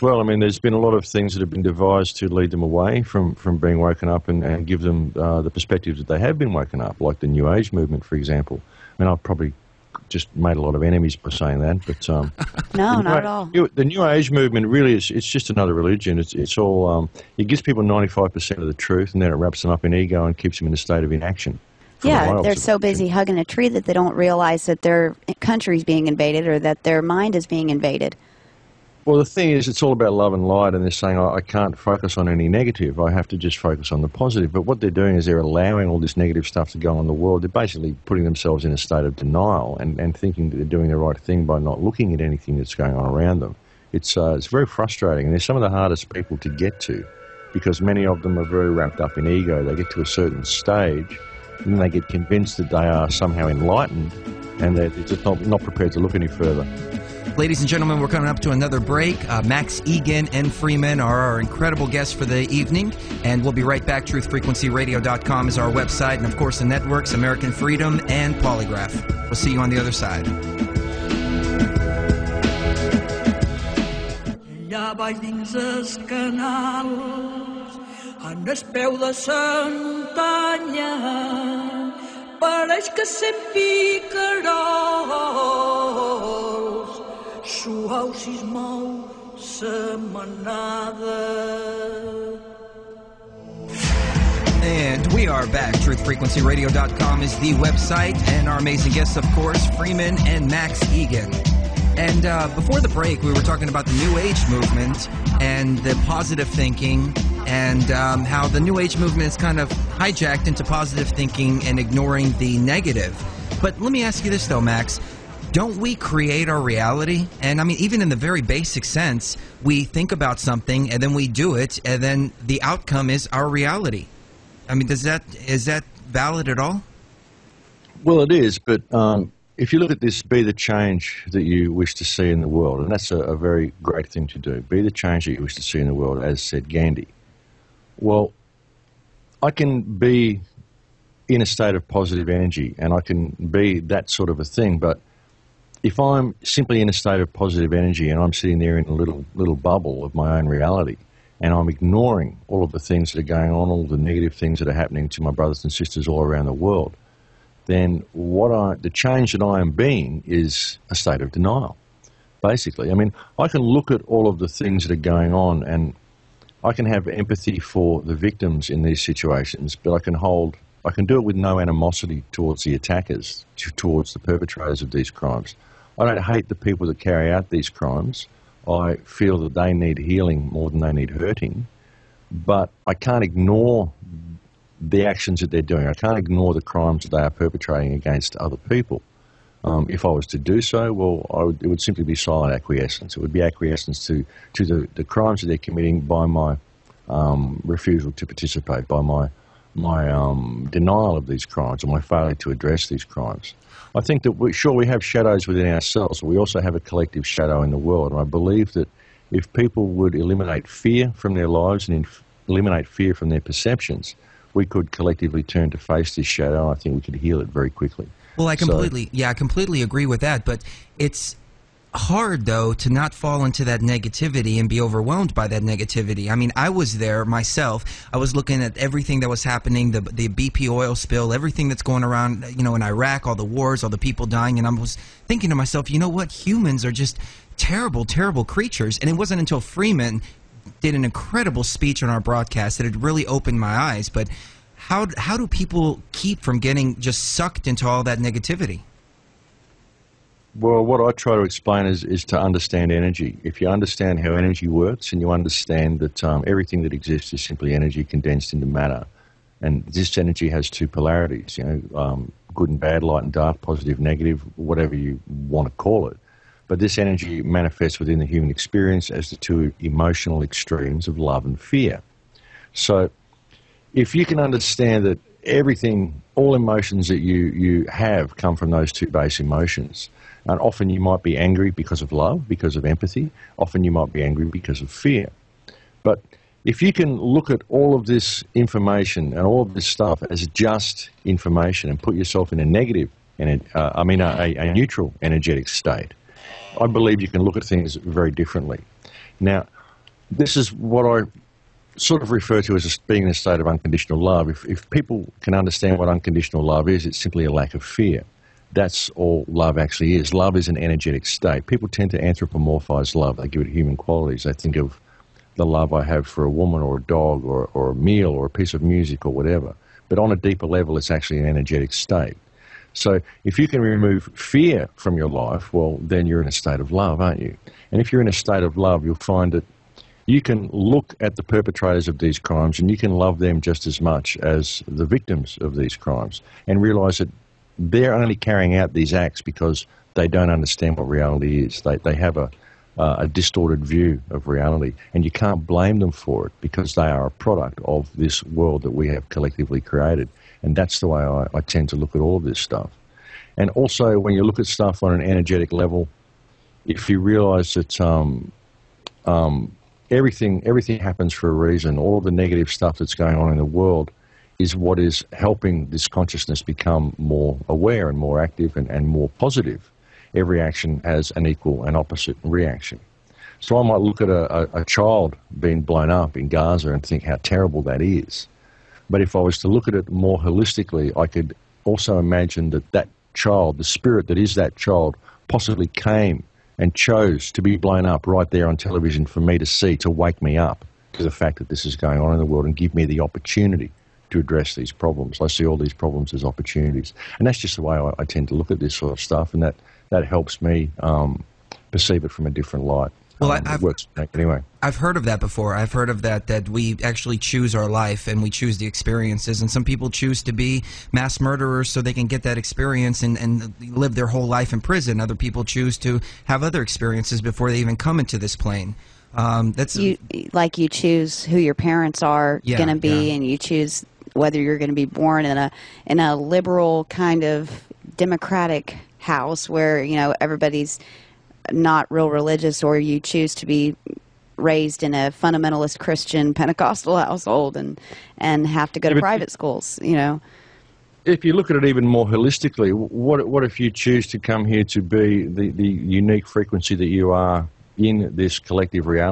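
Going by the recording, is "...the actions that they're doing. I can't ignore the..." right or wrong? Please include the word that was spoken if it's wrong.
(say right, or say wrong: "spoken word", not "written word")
right.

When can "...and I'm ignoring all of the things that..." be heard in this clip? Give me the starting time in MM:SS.
02:31.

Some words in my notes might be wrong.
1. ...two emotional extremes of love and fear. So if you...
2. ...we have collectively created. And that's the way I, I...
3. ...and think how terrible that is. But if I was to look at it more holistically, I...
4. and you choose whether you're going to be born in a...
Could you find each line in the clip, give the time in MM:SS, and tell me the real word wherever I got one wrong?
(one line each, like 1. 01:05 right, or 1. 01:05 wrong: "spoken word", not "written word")
1. 04:29 right
2. 05:48 right
3. 06:16 right
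4. 07:03 right.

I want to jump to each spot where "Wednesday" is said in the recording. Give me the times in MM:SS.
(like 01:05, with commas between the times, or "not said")
not said.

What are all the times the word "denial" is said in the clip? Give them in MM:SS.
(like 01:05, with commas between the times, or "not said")
00:39, 02:41, 03:20.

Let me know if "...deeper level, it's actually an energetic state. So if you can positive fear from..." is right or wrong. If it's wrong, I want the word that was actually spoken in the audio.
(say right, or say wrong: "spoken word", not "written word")
wrong: "remove", not "positive".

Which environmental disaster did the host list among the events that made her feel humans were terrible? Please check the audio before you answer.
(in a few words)
BP oil spill.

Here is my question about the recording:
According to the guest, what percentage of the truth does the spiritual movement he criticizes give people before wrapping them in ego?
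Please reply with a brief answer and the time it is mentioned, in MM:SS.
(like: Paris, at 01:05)
95, at 00:17.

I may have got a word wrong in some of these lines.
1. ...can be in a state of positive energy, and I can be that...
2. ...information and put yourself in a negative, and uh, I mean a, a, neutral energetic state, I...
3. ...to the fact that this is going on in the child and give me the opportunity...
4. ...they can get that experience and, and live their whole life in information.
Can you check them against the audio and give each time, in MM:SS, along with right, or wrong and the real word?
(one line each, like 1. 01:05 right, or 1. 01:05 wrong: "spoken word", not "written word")
1. 02:19 right
2. 04:51 right
3. 06:31 wrong: "world", not "child"
4. 06:51 wrong: "prison", not "information".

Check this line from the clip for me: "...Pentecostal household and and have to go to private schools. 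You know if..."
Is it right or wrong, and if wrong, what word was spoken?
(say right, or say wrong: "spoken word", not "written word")
right.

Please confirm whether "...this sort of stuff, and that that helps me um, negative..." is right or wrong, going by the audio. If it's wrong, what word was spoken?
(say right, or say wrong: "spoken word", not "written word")
wrong: "perceive", not "negative".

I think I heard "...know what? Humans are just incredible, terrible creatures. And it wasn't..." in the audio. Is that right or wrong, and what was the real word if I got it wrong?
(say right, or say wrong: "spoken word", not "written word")
wrong: "terrible", not "incredible".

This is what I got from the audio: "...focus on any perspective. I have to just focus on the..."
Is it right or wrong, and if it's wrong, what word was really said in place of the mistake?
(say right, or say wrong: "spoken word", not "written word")
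wrong: "negative", not "perspective".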